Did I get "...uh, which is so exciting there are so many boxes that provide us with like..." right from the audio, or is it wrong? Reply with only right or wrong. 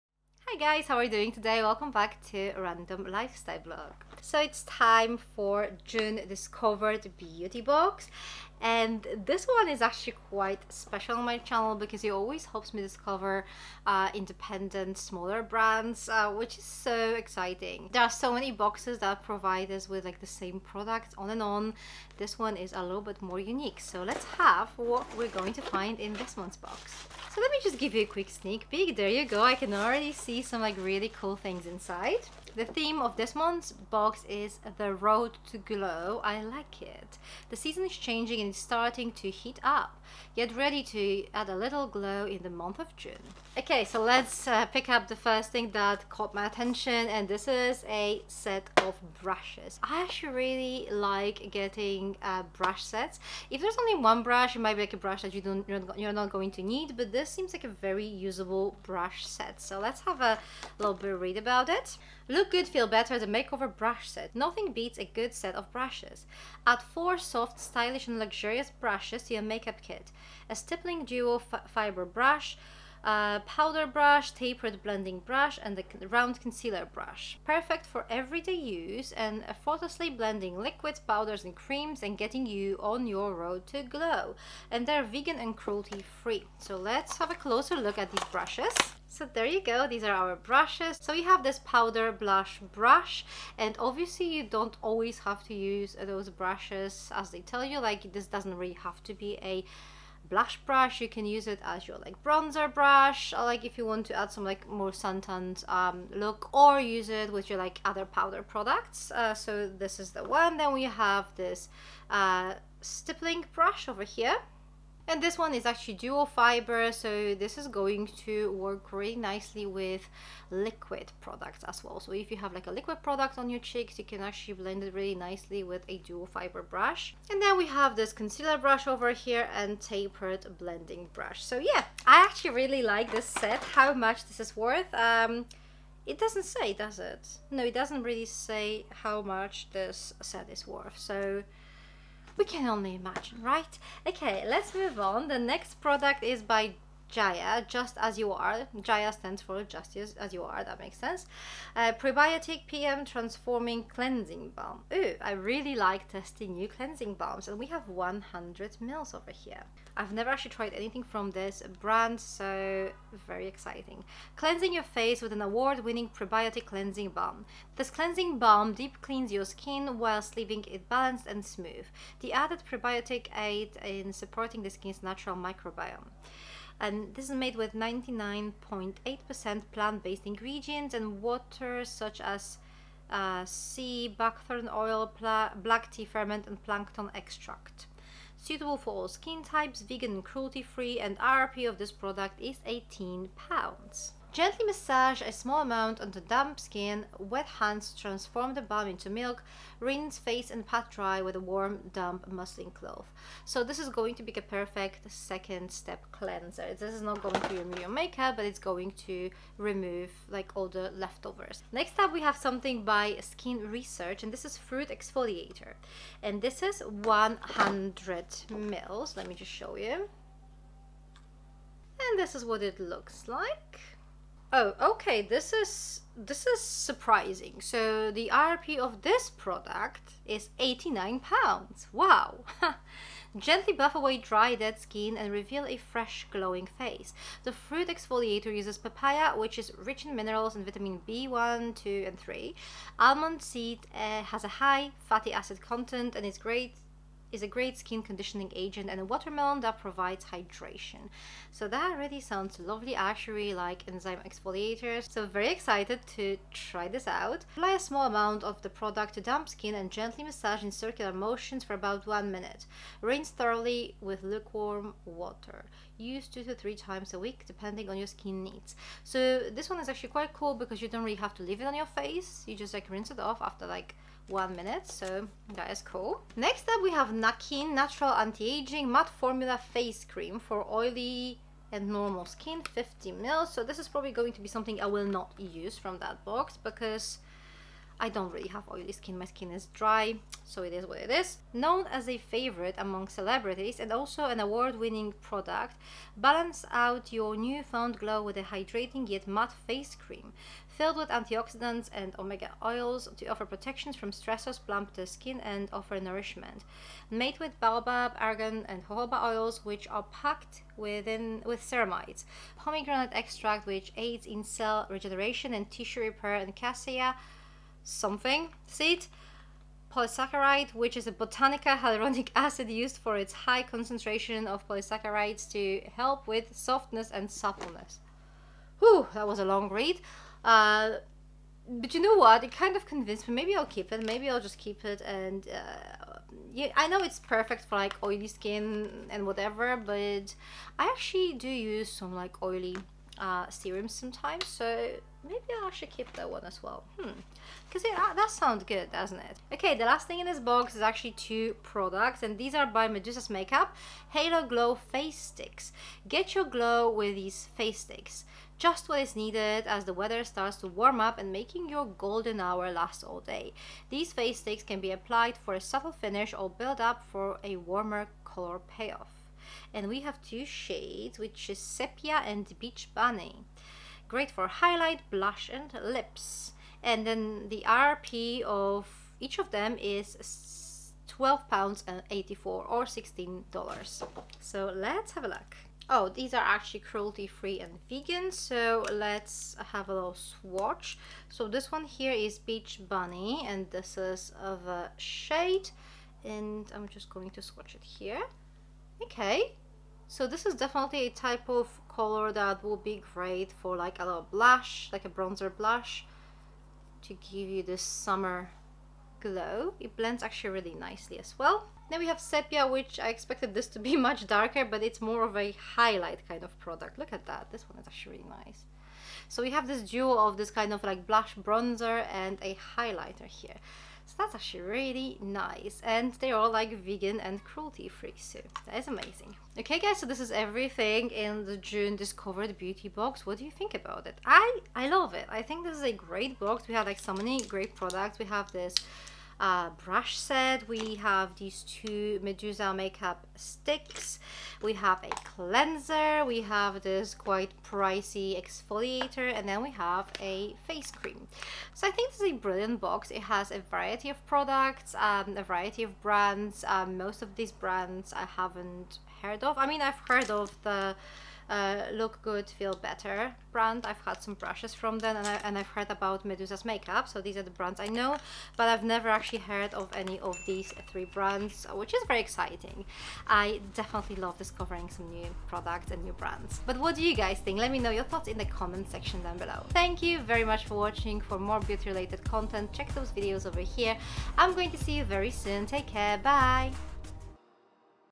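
right.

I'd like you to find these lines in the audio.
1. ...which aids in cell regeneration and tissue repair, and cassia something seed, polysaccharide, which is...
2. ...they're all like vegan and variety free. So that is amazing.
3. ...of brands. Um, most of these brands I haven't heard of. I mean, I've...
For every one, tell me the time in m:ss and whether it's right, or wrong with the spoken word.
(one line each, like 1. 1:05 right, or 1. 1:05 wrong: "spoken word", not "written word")
1. 5:13 right
2. 7:06 wrong: "cruelty", not "variety"
3. 7:35 right.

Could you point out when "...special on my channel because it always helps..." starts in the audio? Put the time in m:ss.
0:10.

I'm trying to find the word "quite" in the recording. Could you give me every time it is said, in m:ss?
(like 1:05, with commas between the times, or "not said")
0:10, 4:30, 7:27.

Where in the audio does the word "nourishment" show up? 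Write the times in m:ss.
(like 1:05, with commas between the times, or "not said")
5:05.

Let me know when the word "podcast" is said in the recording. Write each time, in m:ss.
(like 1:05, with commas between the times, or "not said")
not said.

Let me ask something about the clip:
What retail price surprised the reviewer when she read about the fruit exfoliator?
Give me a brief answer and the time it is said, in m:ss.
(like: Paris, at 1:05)
89 pounds, at 3:50.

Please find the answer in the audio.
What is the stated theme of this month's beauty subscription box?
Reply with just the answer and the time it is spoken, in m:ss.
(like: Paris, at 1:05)
The road to glow, at 0:34.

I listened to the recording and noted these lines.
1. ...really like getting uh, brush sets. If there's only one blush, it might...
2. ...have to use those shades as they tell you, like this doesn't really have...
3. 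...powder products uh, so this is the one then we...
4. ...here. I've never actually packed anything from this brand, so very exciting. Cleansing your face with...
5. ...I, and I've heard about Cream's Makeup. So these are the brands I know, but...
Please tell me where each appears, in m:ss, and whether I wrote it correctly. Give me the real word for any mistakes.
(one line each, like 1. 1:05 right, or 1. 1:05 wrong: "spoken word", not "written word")
1. 0:50 wrong: "brush", not "blush"
2. 1:35 wrong: "brushes", not "shades"
3. 1:48 right
4. 2:39 wrong: "tried", not "packed"
5. 7:45 wrong: "Medusa", not "Cream".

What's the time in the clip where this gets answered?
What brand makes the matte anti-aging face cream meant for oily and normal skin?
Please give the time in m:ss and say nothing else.
4:37.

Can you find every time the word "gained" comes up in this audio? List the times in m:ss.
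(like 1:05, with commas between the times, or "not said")
not said.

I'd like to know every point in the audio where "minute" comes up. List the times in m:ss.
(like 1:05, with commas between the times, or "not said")
4:22, 4:34.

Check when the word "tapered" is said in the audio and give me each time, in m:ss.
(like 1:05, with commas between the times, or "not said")
1:14, 2:09.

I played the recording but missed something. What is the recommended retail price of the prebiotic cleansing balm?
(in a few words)
18 pounds.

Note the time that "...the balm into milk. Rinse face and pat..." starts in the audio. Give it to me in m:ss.
3:18.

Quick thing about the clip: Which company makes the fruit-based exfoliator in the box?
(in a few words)
Skin Research.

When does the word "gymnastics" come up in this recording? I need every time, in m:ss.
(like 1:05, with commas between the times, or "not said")
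not said.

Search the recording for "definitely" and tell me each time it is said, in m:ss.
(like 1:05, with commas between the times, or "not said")
6:40, 7:53.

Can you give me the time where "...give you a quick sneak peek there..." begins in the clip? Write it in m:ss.
0:27.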